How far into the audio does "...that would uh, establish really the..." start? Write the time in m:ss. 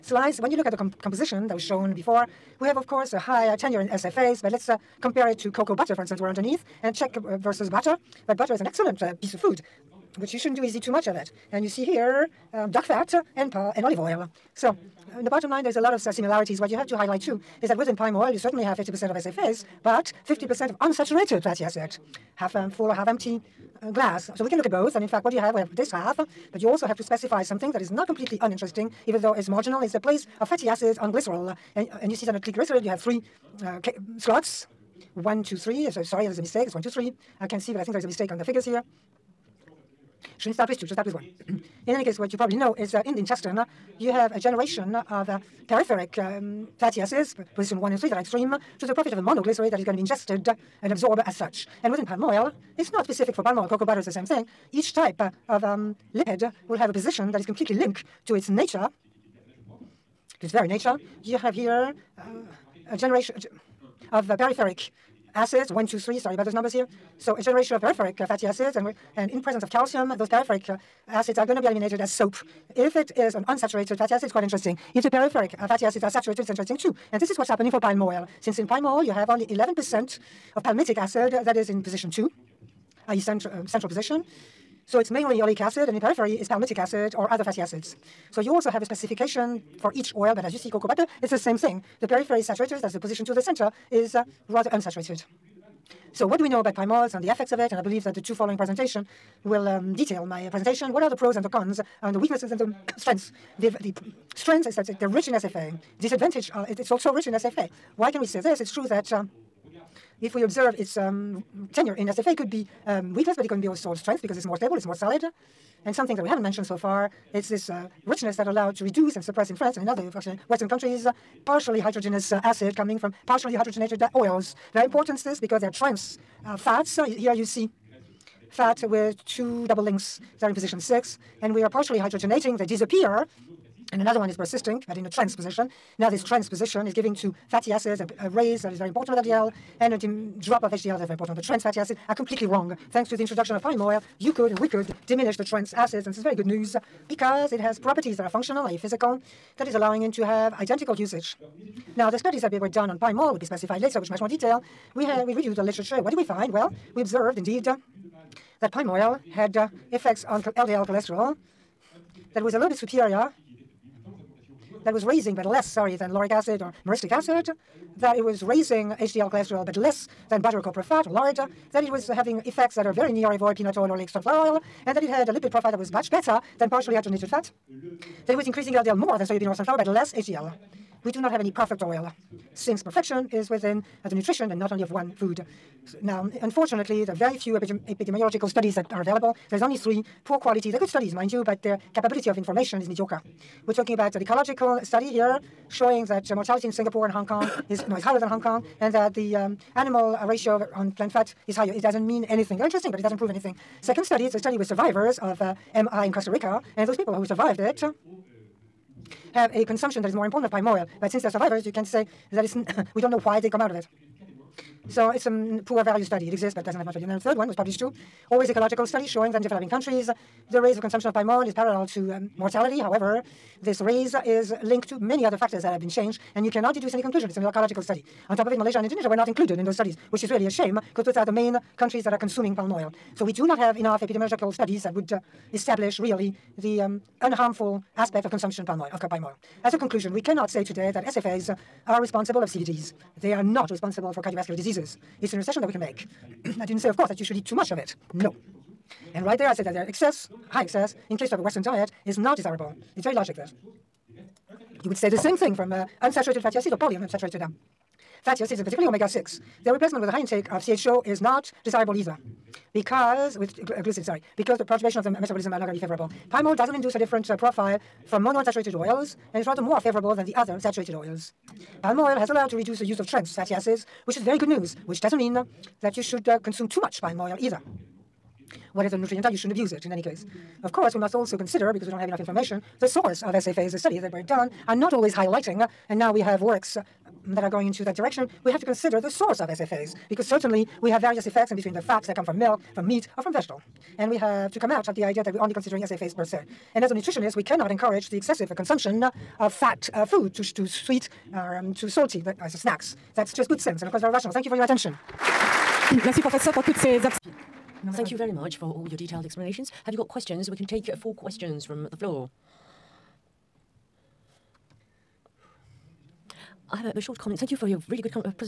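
3:54.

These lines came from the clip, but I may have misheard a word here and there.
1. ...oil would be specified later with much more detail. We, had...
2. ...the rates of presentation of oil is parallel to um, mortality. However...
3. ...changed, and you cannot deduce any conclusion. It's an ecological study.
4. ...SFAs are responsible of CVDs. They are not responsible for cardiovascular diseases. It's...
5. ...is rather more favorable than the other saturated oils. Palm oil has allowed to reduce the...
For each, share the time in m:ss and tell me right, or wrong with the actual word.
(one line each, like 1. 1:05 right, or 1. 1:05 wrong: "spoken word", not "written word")
1. 2:33 right
2. 3:40 wrong: "consumption", not "presentation"
3. 3:45 right
4. 4:01 right
5. 4:29 right.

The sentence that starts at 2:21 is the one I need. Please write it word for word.
The trans fatty acids are completely wrong.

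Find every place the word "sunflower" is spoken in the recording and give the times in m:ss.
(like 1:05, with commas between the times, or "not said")
2:54, 2:59.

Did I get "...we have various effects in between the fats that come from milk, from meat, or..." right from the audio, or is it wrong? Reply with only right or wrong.
right.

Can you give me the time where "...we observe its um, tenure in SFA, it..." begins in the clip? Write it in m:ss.
1:50.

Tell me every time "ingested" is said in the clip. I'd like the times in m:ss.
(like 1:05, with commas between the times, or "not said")
0:50.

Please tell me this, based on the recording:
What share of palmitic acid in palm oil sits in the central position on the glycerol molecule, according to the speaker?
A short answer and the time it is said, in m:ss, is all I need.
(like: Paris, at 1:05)
11%, at 1:19.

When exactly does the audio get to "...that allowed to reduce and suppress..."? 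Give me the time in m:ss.
1:58.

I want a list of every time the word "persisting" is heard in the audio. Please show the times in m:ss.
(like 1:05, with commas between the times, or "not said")
2:14.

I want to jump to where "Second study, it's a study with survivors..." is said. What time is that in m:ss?
3:23.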